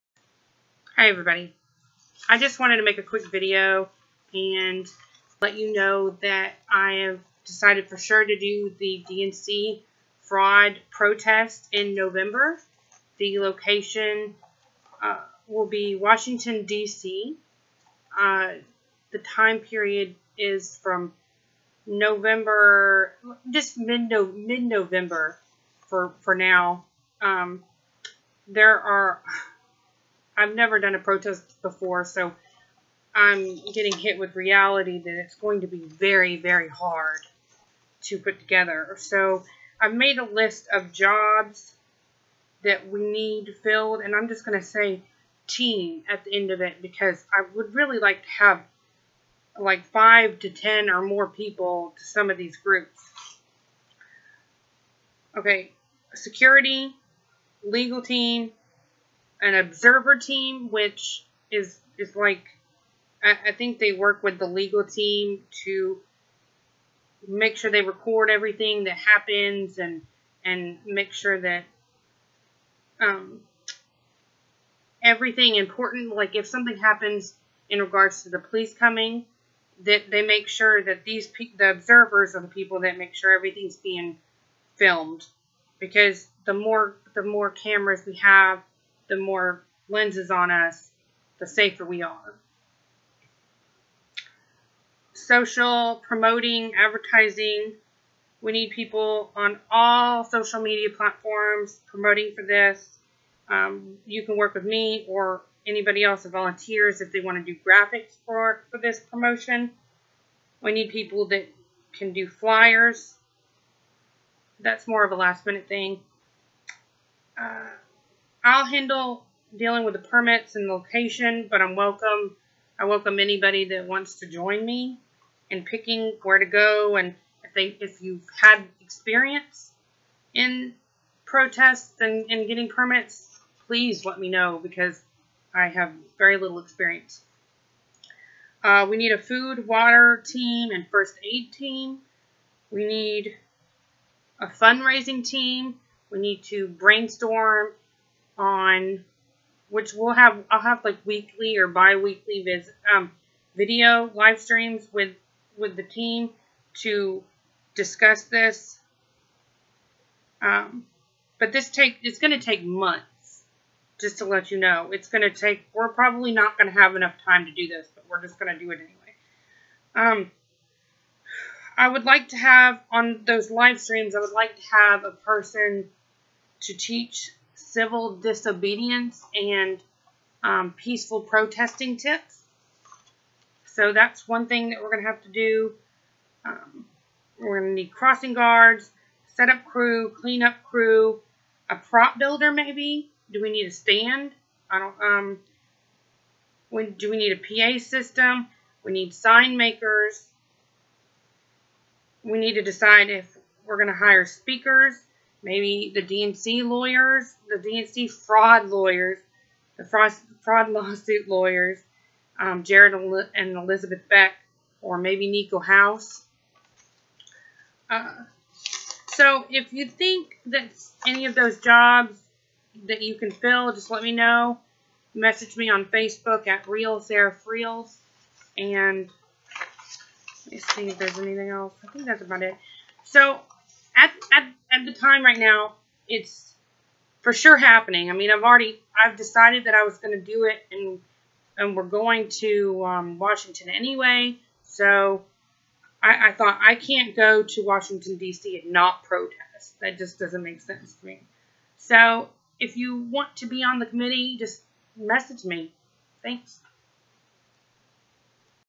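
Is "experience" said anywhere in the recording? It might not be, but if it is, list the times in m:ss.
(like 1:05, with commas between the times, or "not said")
2:08, 2:16.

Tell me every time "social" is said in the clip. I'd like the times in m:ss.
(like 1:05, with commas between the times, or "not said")
1:35, 1:40.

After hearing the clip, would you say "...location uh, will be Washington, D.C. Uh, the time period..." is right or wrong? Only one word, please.
right.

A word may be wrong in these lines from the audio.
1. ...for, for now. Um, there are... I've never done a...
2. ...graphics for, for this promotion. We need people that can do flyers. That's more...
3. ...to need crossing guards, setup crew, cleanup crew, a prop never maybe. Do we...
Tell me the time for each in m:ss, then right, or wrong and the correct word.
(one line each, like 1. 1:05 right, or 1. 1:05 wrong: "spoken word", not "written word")
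1. 0:25 right
2. 1:47 right
3. 3:07 wrong: "builder", not "never".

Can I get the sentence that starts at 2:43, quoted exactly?
Just to let you know, it's going to take.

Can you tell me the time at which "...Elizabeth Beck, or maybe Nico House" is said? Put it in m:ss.
3:33.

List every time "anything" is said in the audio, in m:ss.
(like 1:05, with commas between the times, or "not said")
3:51.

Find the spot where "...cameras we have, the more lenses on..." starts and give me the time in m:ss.
1:27.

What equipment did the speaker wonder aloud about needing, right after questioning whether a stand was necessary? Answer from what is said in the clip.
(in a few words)
PA system.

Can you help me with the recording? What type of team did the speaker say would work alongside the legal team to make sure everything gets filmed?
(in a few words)
Observer team.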